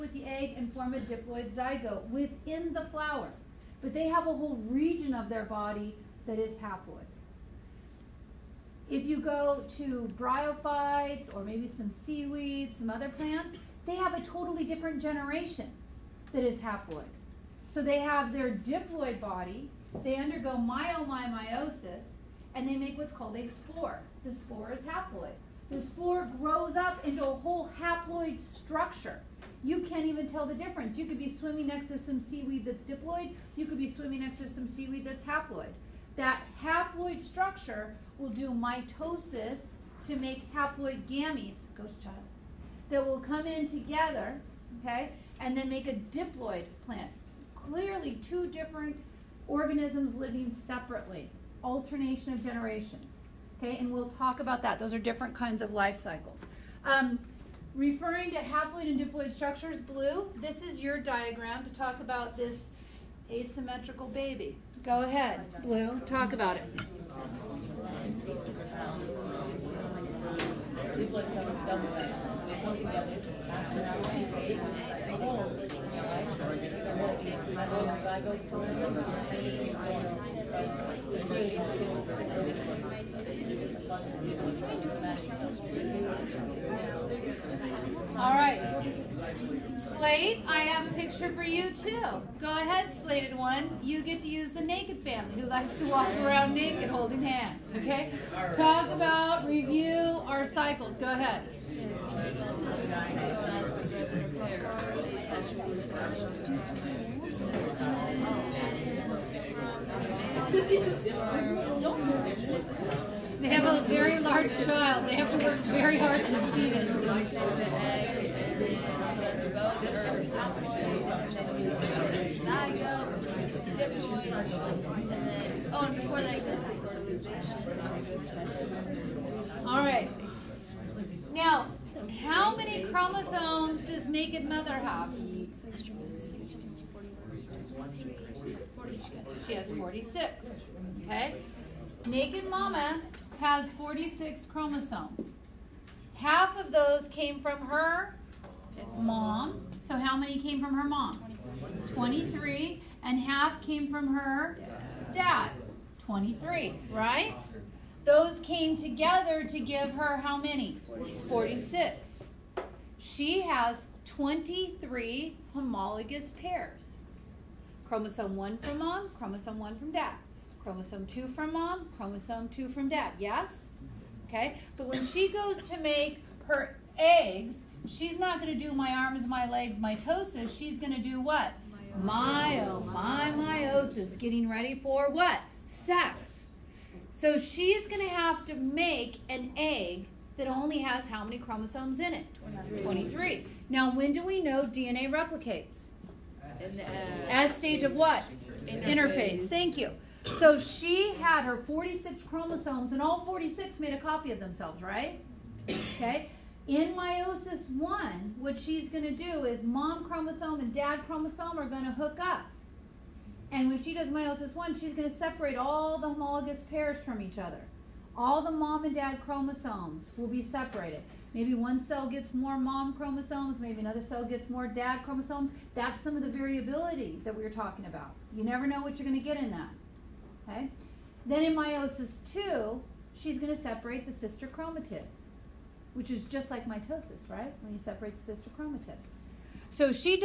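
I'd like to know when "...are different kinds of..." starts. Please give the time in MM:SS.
00:54.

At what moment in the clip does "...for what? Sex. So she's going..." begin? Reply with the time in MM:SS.
03:04.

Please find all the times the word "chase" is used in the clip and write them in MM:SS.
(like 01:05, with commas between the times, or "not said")
not said.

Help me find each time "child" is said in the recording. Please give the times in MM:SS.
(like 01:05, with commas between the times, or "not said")
00:42, 01:54.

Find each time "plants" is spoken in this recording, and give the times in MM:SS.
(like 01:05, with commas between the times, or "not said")
00:13, 00:46.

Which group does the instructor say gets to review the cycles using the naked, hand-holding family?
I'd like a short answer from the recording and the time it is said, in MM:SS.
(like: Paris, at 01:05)
Slate, at 01:29.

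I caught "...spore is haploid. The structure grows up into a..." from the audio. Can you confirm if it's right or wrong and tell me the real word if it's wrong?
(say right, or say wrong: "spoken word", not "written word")
wrong: "spore", not "structure".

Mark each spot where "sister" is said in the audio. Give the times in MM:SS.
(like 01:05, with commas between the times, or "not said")
03:54, 03:58.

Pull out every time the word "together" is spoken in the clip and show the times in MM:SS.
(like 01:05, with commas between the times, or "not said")
00:43, 02:38.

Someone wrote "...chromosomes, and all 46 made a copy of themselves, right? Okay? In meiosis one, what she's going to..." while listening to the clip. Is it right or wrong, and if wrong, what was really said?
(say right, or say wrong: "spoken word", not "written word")
right.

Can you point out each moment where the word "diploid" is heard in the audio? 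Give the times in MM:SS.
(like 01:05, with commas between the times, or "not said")
00:00, 00:18, 00:32, 00:46, 00:58.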